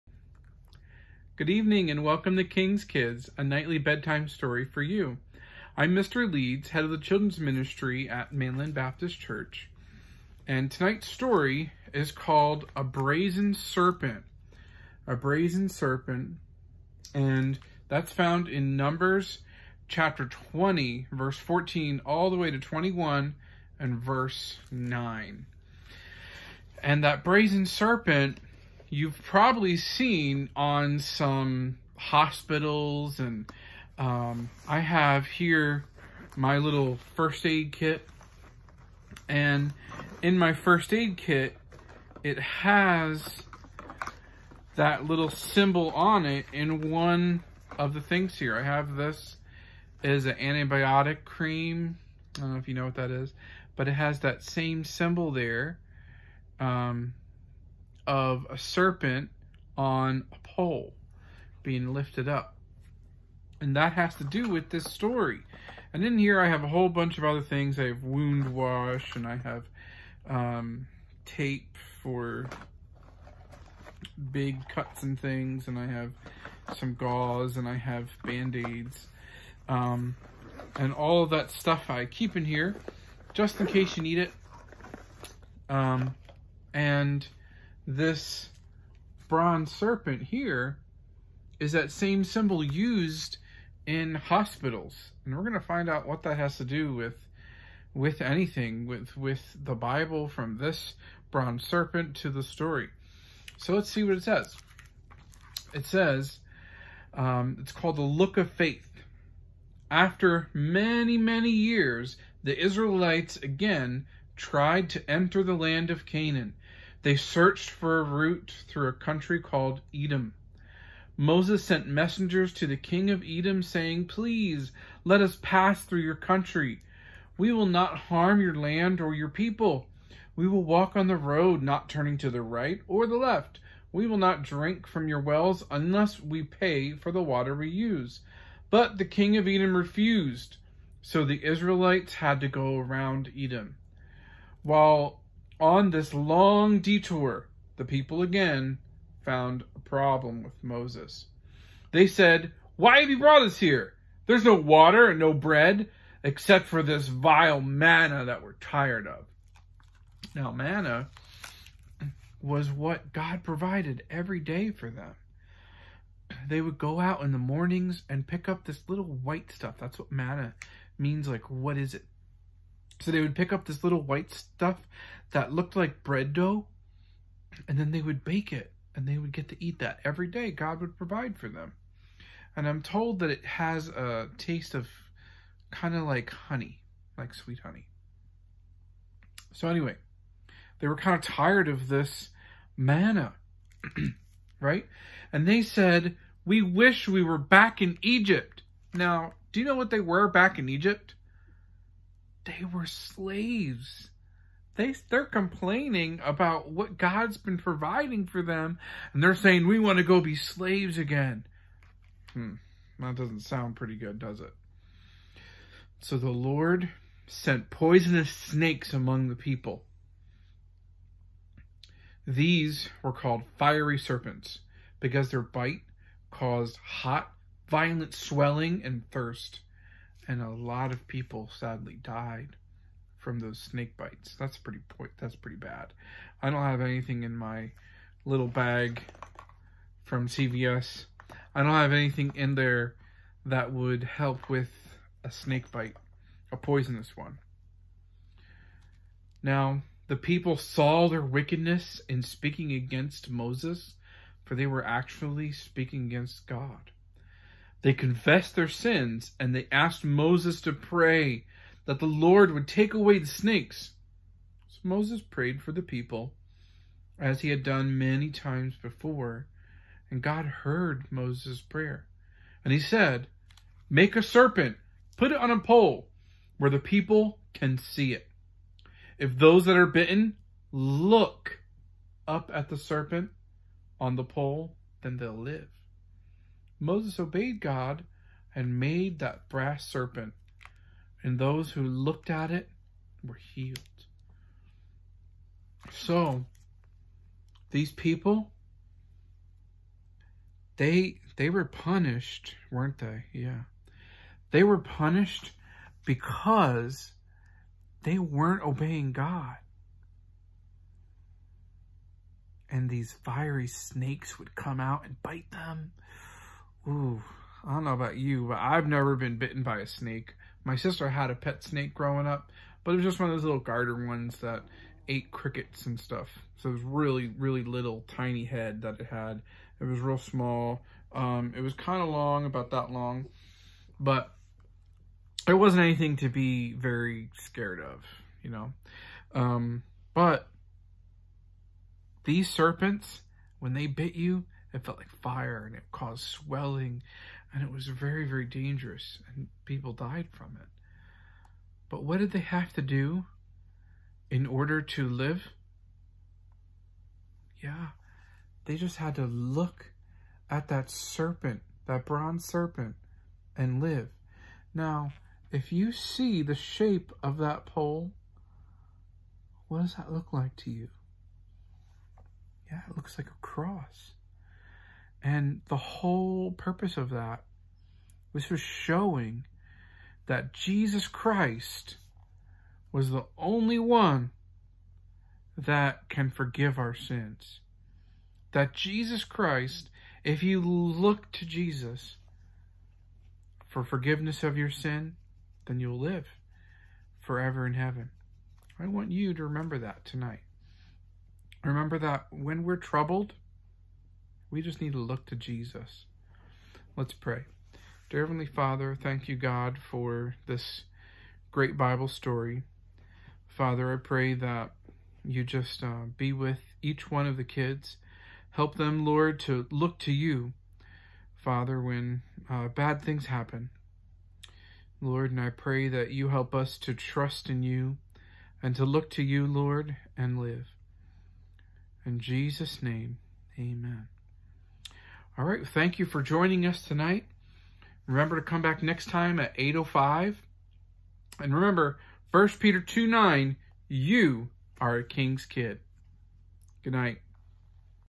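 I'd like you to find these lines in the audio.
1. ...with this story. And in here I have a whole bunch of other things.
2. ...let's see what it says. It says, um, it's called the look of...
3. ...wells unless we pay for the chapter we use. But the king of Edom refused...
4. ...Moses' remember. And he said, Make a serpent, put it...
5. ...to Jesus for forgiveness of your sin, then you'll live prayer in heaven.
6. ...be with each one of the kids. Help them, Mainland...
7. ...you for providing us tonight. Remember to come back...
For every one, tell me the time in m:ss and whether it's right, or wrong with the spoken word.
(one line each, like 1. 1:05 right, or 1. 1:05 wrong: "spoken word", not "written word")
1. 1:04 right
2. 1:43 right
3. 2:15 wrong: "water", not "chapter"
4. 4:31 wrong: "prayer", not "remember"
5. 6:31 wrong: "forever", not "prayer"
6. 6:56 wrong: "Lord", not "Mainland"
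7. 7:15 wrong: "joining", not "providing".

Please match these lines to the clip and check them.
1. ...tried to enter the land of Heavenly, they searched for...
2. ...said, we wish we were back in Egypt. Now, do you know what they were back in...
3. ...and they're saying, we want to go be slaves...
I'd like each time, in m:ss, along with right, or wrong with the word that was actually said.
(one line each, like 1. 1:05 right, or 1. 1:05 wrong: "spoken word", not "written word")
1. 1:54 wrong: "Canaan", not "Heavenly"
2. 3:15 right
3. 3:29 right.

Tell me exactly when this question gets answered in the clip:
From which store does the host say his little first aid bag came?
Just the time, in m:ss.
4:00.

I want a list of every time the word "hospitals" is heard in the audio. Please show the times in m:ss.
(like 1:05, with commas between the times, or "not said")
0:31, 1:34.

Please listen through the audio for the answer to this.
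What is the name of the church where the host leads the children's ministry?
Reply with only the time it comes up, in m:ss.
0:08.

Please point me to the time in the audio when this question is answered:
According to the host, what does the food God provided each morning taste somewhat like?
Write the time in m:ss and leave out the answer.
3:07.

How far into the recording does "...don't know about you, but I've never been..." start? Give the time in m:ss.
5:17.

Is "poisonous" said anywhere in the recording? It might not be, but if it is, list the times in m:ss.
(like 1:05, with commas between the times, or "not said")
3:37, 4:06.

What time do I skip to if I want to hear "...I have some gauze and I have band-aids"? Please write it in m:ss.
1:15.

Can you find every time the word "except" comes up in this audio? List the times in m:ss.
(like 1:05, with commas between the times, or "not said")
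2:36.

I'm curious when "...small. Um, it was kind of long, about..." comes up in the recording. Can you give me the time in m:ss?
5:30.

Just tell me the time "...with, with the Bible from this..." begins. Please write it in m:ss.
1:38.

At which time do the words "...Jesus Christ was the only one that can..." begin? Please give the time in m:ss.
6:20.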